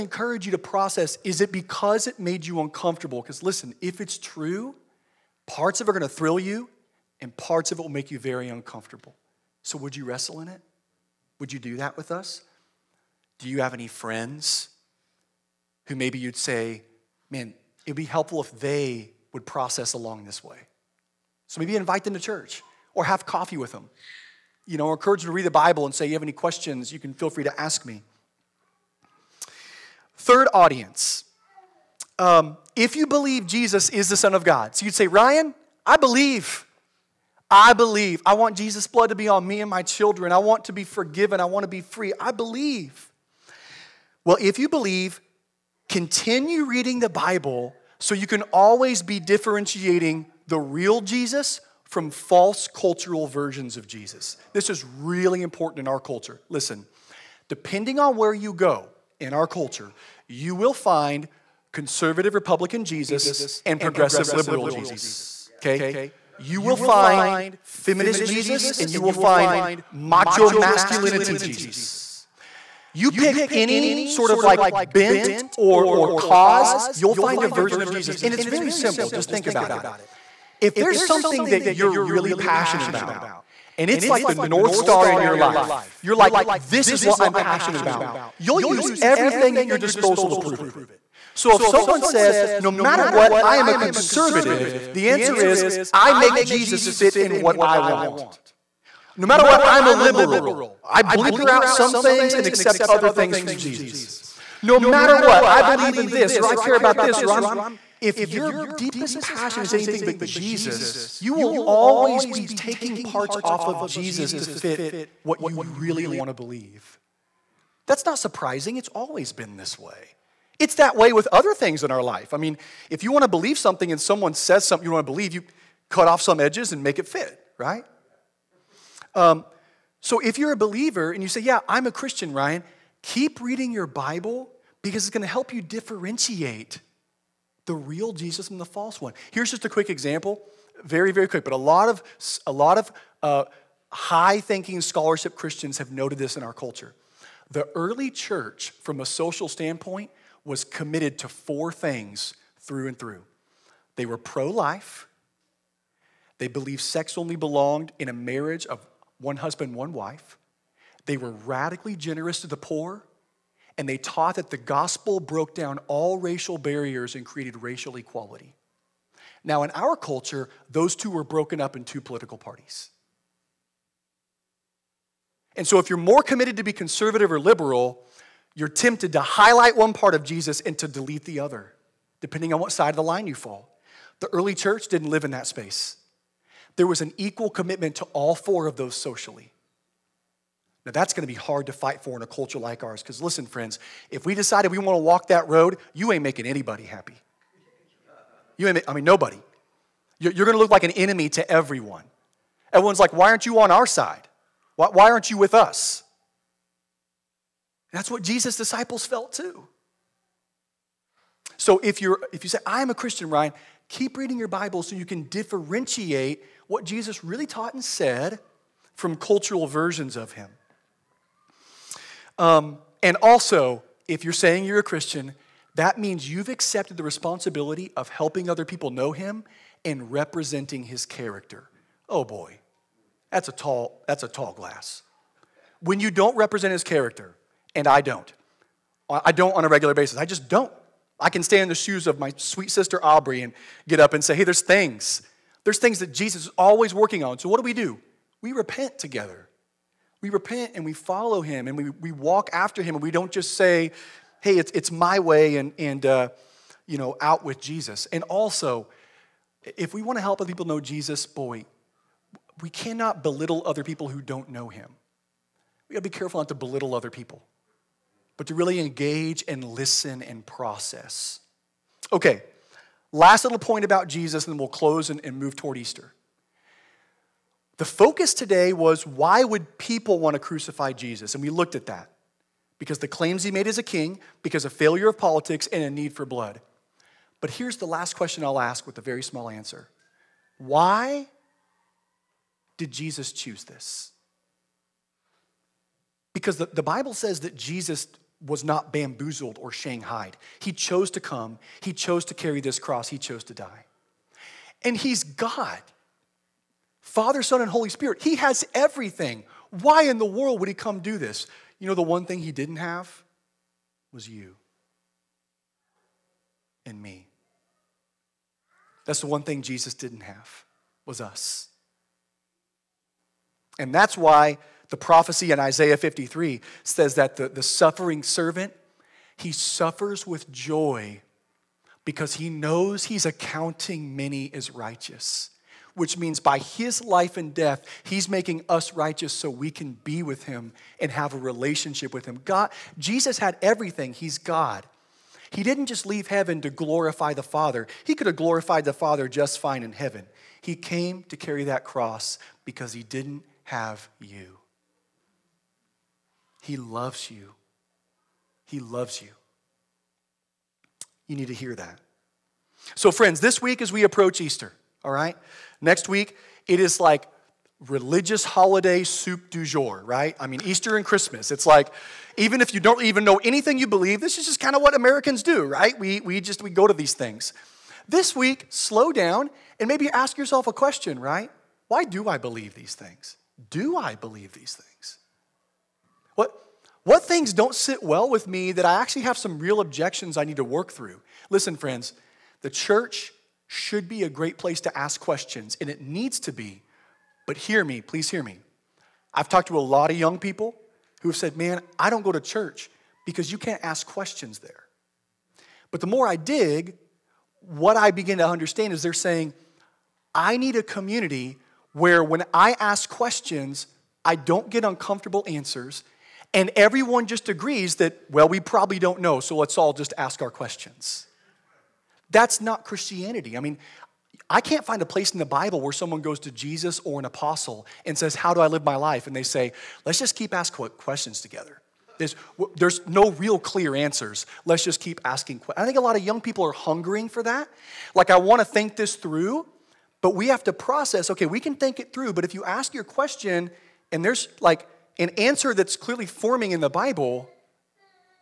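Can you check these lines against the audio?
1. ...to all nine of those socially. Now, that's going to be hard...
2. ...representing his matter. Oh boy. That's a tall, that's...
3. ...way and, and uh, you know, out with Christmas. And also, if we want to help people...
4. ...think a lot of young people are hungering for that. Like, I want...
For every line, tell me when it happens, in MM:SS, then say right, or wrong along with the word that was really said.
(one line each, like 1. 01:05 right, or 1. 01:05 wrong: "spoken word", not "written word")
1. 03:07 wrong: "four", not "nine"
2. 03:50 wrong: "character", not "matter"
3. 04:15 wrong: "Jesus", not "Christmas"
4. 07:15 right.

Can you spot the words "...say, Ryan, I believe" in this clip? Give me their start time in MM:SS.
00:34.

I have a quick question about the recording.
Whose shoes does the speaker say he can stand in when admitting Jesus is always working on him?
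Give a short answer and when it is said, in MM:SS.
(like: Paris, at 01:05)
Aubrey, at 04:03.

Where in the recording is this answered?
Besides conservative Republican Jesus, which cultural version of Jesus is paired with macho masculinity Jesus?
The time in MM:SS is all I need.
01:07.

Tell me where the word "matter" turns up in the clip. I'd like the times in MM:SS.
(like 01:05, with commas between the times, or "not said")
01:32, 01:39, 01:44.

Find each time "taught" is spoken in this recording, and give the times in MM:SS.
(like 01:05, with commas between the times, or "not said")
02:43, 03:37.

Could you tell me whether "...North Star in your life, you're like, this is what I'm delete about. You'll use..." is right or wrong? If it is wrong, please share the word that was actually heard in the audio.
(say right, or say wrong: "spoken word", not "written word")
wrong: "passionate", not "delete".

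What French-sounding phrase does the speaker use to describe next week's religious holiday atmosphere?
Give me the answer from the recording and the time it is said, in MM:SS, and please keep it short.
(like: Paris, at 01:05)
soup du jour, at 06:09.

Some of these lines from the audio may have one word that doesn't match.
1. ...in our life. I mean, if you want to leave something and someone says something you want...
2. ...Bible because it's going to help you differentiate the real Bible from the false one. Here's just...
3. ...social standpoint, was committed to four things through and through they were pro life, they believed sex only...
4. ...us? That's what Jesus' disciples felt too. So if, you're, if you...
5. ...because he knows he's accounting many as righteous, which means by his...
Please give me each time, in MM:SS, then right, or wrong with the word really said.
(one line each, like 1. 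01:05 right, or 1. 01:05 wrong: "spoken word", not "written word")
1. 02:01 wrong: "believe", not "leave"
2. 02:13 wrong: "Jesus", not "Bible"
3. 02:29 right
4. 03:25 right
5. 05:32 right.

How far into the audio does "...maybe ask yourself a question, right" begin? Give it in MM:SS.
06:19.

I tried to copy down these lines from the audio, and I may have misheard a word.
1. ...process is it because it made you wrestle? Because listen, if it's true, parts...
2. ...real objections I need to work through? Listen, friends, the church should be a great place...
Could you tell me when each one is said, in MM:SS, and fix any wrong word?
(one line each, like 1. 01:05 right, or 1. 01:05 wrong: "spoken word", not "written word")
1. 00:00 wrong: "uncomfortable", not "wrestle"
2. 06:29 right.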